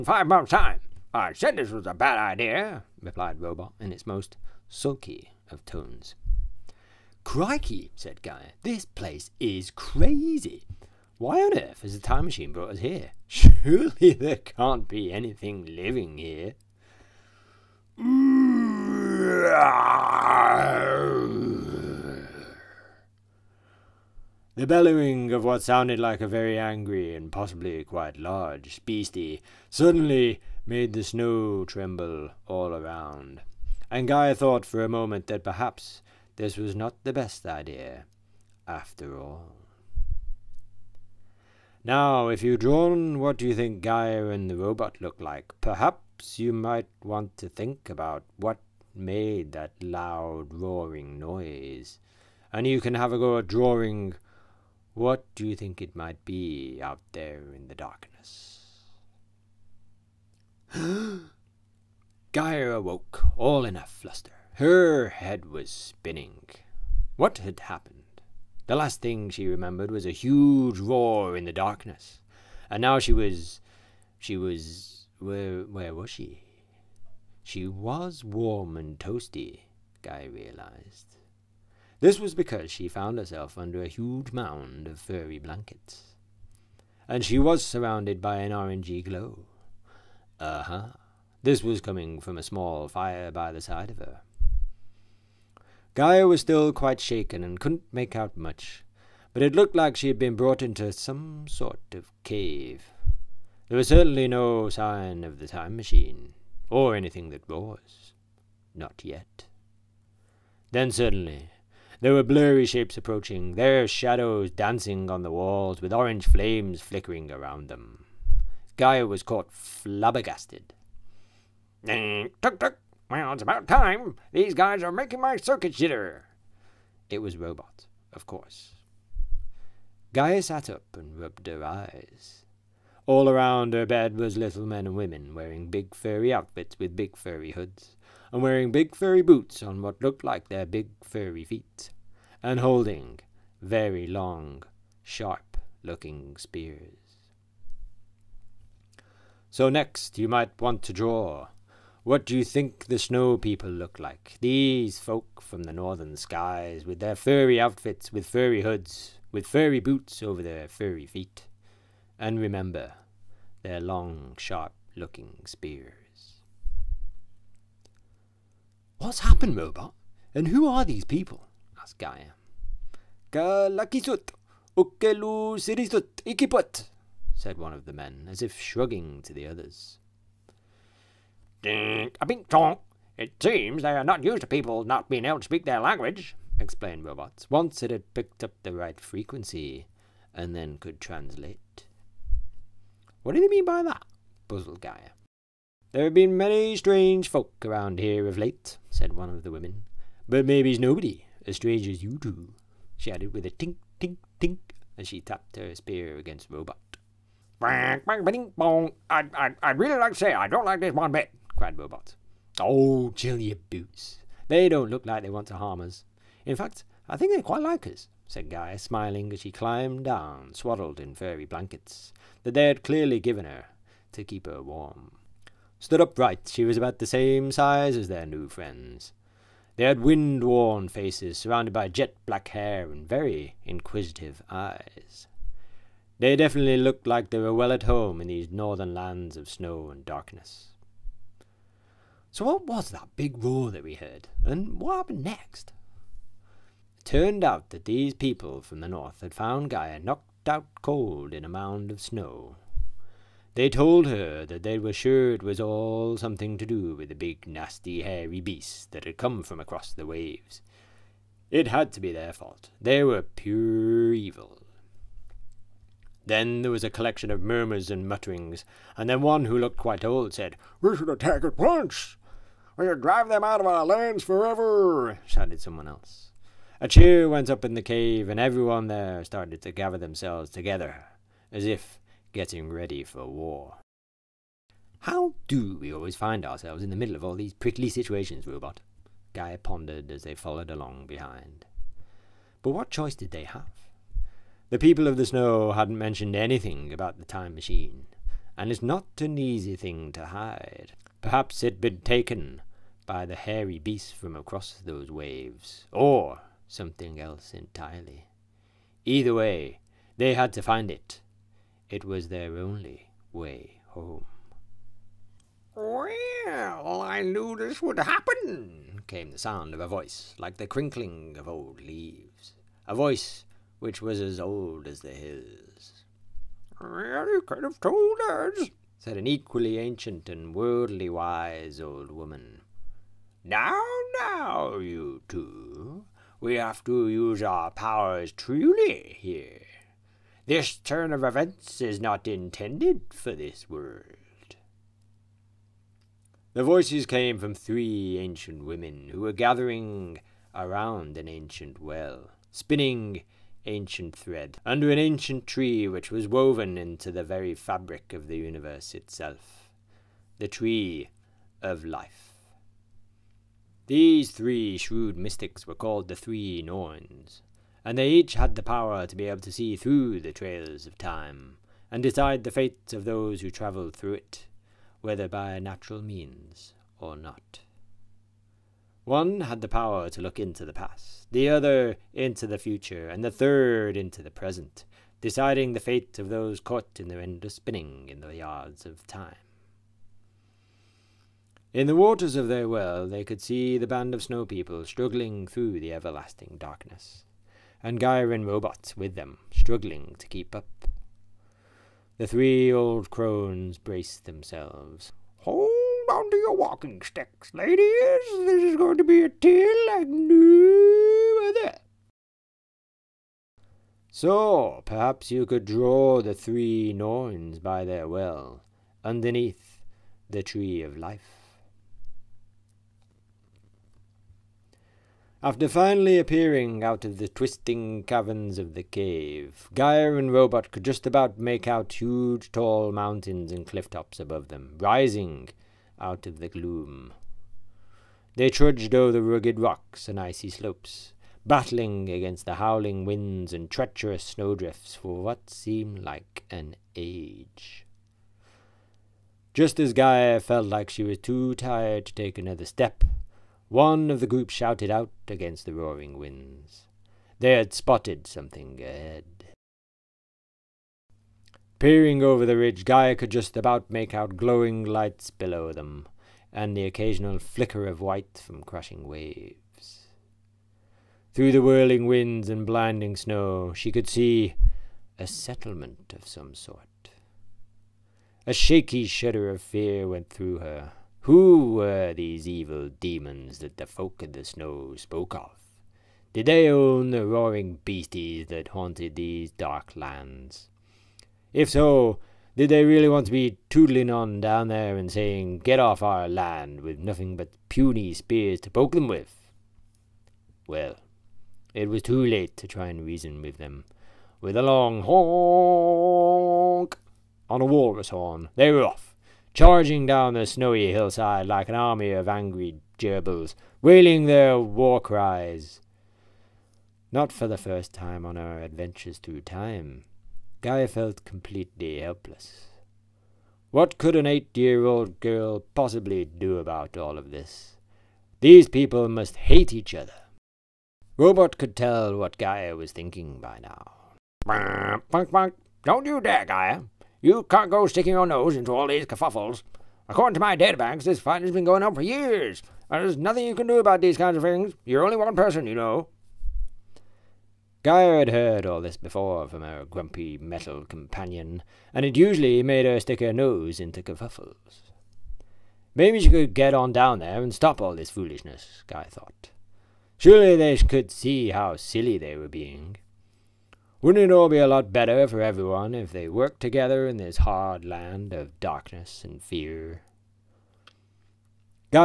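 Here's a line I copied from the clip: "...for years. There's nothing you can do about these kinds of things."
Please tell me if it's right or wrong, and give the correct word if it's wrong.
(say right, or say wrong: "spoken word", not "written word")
right.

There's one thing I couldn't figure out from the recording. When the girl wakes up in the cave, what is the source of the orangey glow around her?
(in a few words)
A small fire.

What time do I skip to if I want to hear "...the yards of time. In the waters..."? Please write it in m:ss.
6:28.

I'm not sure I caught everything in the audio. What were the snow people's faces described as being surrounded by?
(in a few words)
Jet black hair.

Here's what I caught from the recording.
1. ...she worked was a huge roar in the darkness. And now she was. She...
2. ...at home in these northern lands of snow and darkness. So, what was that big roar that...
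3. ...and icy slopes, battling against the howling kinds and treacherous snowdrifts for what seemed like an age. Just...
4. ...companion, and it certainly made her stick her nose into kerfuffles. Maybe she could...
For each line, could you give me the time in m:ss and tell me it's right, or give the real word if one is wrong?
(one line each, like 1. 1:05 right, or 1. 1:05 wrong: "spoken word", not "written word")
1. 1:09 wrong: "remembered", not "worked"
2. 3:57 right
3. 7:20 wrong: "winds", not "kinds"
4. 9:10 wrong: "usually", not "certainly".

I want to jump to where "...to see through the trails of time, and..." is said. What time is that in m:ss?
6:09.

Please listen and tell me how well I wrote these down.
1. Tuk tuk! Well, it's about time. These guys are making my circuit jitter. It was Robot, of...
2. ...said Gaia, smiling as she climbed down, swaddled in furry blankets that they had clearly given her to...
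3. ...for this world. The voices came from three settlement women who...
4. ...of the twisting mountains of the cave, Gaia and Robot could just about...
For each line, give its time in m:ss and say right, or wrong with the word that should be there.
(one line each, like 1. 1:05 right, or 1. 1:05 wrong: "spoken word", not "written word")
1. 2:01 right
2. 3:38 right
3. 5:43 wrong: "ancient", not "settlement"
4. 7:07 wrong: "caverns", not "mountains".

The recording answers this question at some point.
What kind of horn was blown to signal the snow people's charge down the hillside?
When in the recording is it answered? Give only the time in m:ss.
8:27.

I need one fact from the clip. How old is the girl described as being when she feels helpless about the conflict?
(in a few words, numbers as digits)
8.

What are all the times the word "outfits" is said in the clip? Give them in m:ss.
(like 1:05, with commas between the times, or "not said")
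2:16, 2:37.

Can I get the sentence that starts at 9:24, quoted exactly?
Wouldn't it all be a lot better for everyone if they worked together in this hard land of darkness and fear?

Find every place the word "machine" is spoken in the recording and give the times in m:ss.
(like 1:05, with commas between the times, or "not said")
0:12, 1:45, 4:57.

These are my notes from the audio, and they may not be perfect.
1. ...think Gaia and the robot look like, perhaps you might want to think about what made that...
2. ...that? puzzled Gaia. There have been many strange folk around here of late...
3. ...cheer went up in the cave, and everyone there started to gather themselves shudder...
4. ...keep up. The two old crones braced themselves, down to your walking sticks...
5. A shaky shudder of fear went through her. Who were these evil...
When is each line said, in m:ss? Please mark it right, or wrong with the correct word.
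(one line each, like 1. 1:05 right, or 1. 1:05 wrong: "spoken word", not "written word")
1. 0:43 right
2. 3:13 right
3. 4:36 wrong: "together", not "shudder"
4. 6:40 wrong: "three", not "two"
5. 7:58 right.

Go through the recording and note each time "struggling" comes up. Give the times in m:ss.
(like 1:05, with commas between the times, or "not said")
6:34, 6:39.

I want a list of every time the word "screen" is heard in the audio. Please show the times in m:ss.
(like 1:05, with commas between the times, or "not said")
not said.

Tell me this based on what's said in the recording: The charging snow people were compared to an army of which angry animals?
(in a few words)
Gerbils.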